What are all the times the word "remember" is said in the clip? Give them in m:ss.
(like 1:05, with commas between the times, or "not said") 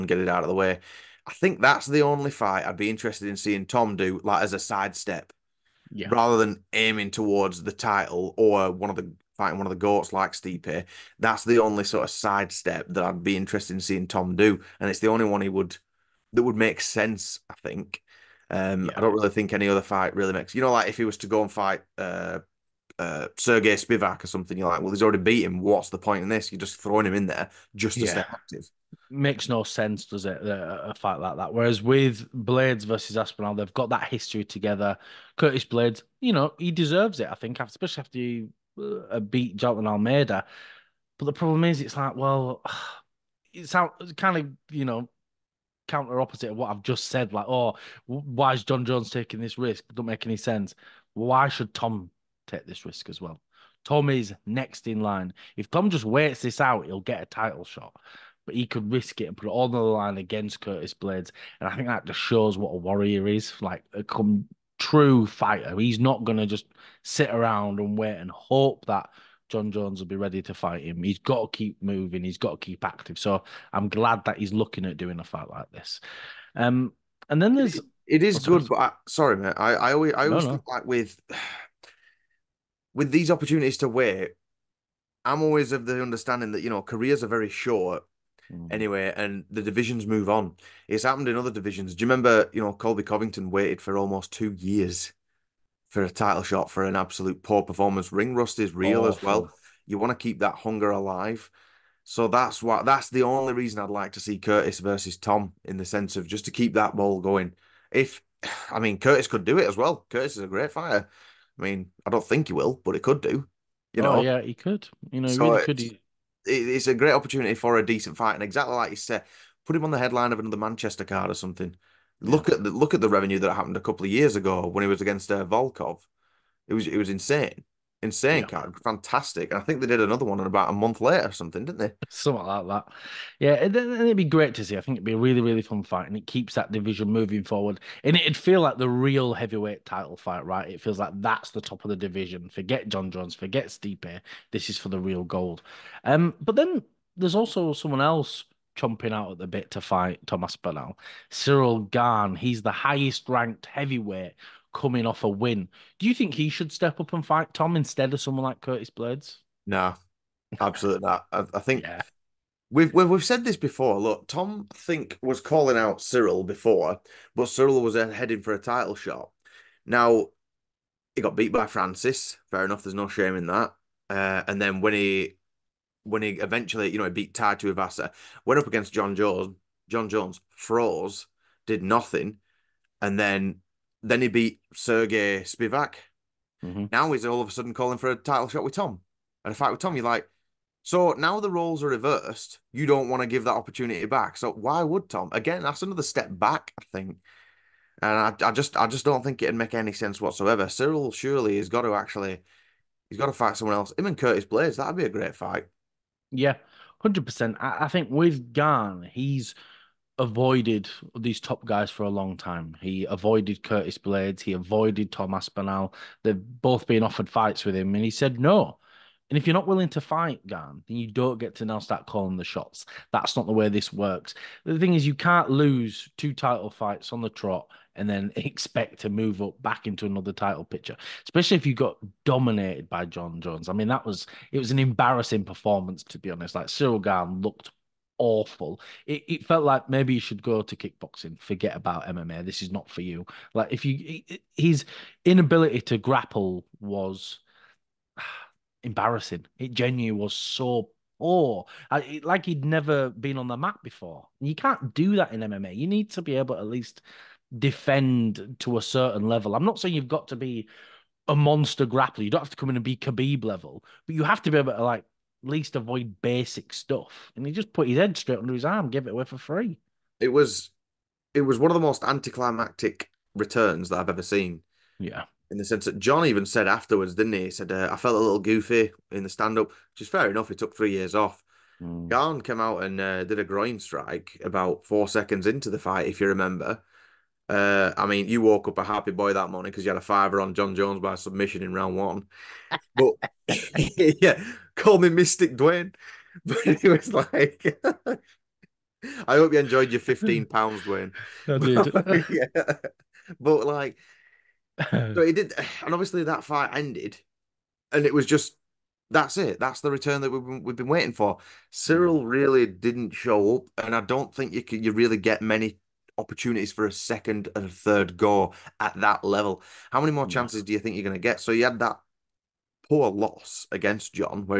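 1:32, 4:46.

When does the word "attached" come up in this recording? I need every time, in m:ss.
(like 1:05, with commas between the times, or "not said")
not said.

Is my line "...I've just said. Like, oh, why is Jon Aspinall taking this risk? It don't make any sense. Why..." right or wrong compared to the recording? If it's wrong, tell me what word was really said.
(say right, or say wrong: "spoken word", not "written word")
wrong: "Jones", not "Aspinall".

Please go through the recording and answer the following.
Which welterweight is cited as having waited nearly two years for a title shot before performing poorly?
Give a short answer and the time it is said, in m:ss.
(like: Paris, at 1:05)
Colby Covington, at 1:32.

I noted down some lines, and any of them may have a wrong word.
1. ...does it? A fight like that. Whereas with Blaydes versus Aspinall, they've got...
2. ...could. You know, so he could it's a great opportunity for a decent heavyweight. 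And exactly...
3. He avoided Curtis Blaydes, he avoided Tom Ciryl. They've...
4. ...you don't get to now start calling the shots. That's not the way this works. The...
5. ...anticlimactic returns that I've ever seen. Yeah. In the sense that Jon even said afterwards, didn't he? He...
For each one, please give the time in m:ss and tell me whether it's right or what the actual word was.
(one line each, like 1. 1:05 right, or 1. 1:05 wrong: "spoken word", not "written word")
1. 0:30 right
2. 1:54 wrong: "fight", not "heavyweight"
3. 3:32 wrong: "Aspinall", not "Ciryl"
4. 3:40 right
5. 4:32 right.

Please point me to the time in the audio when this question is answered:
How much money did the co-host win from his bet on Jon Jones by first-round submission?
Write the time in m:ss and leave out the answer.
4:59.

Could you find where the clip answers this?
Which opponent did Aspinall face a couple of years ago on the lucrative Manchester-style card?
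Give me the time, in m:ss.
2:05.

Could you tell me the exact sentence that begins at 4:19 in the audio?
I'm not saying you've got to be a monster grappler.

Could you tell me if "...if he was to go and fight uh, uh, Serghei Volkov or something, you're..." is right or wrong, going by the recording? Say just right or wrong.
wrong.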